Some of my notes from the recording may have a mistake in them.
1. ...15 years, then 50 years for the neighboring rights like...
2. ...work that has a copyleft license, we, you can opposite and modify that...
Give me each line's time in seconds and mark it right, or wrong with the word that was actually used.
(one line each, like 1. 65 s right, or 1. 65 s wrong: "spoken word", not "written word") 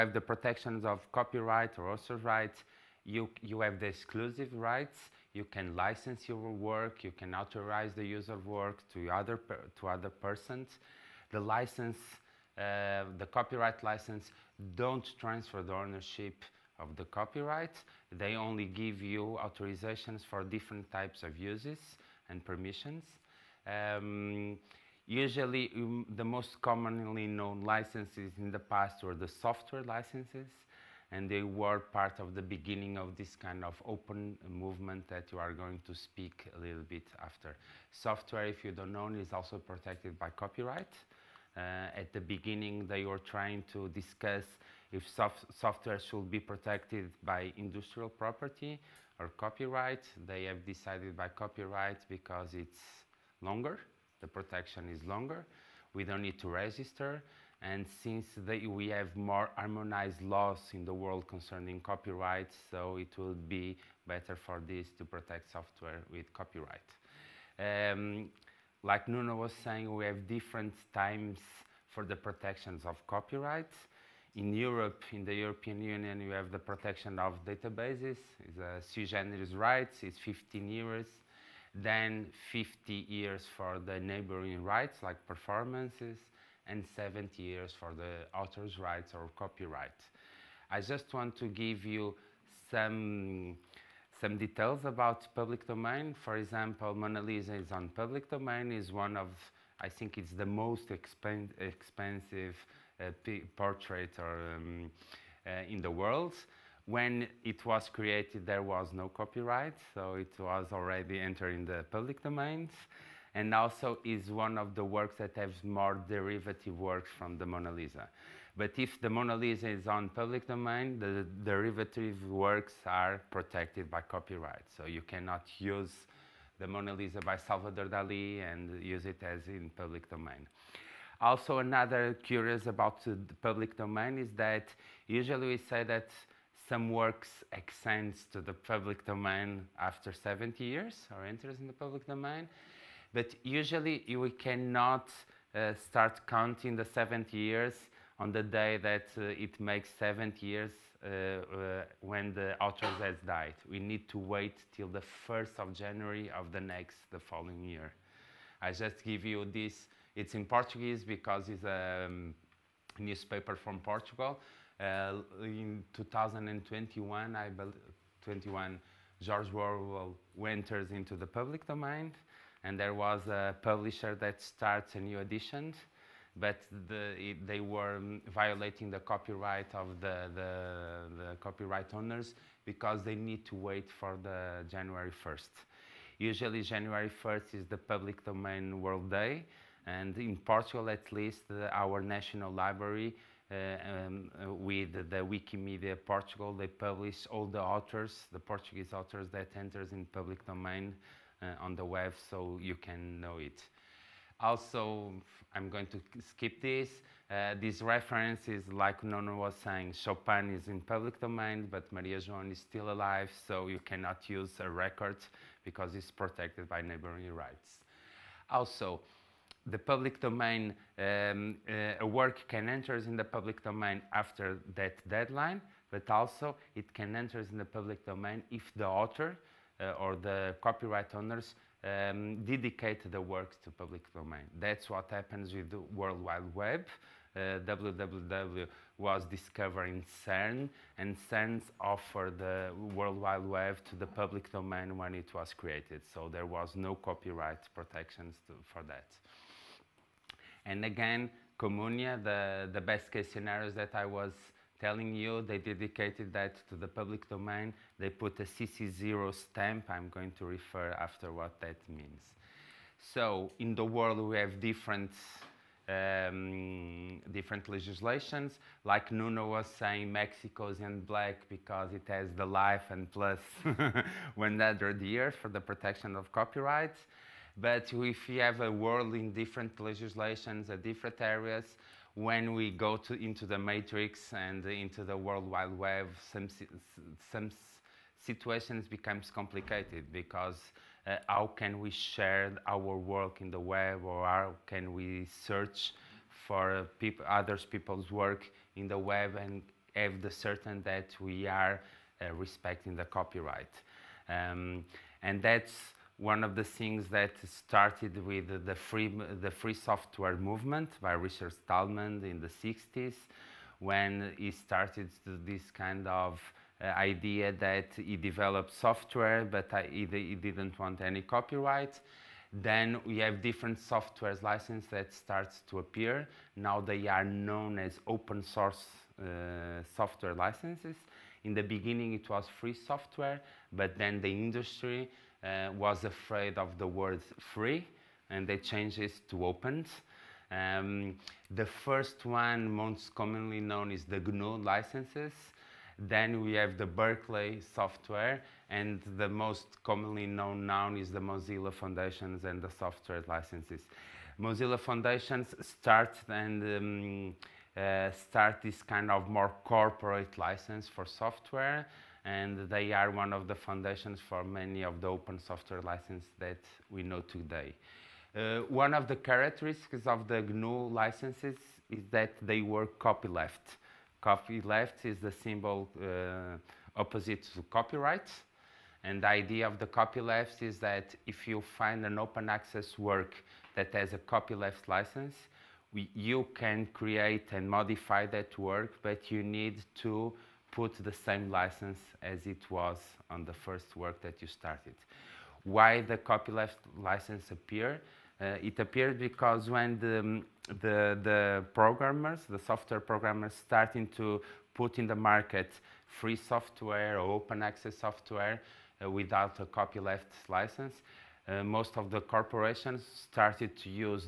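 1. 80 s right
2. 382 s wrong: "create", not "opposite".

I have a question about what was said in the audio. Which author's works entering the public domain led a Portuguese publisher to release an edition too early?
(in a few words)
George Orwell.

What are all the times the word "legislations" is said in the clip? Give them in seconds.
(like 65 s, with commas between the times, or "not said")
267 s, 279 s.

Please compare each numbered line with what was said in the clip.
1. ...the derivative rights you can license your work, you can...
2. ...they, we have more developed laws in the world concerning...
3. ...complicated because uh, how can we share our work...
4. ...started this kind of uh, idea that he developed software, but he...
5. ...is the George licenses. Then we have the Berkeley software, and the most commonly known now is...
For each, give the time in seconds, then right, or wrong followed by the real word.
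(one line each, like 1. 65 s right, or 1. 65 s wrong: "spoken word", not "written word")
1. 3 s wrong: "exclusive", not "derivative"
2. 58 s wrong: "harmonized", not "developed"
3. 289 s right
4. 314 s right
5. 343 s wrong: "GNU", not "George".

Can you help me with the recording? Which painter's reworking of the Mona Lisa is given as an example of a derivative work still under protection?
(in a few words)
Salvador Dali.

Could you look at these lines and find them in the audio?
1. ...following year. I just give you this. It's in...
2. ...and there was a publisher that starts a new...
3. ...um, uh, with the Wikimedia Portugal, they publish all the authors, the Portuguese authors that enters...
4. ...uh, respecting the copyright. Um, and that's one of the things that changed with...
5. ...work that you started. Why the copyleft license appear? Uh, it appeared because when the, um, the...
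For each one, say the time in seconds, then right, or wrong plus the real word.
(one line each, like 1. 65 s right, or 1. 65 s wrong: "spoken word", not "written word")
1. 157 s right
2. 172 s right
3. 194 s right
4. 302 s wrong: "started", not "changed"
5. 393 s right.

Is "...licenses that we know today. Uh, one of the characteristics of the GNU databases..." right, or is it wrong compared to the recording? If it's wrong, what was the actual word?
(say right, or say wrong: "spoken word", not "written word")
wrong: "licenses", not "databases".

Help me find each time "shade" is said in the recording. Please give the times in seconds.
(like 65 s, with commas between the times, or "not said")
not said.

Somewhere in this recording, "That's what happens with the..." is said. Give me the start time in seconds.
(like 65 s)
234 s.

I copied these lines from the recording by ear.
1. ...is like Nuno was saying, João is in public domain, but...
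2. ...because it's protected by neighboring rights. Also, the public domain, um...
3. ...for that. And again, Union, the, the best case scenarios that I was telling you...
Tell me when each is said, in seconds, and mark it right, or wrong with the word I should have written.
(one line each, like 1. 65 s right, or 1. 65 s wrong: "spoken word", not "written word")
1. 208 s wrong: "Chopin", not "João"
2. 215 s right
3. 248 s wrong: "Communia", not "Union".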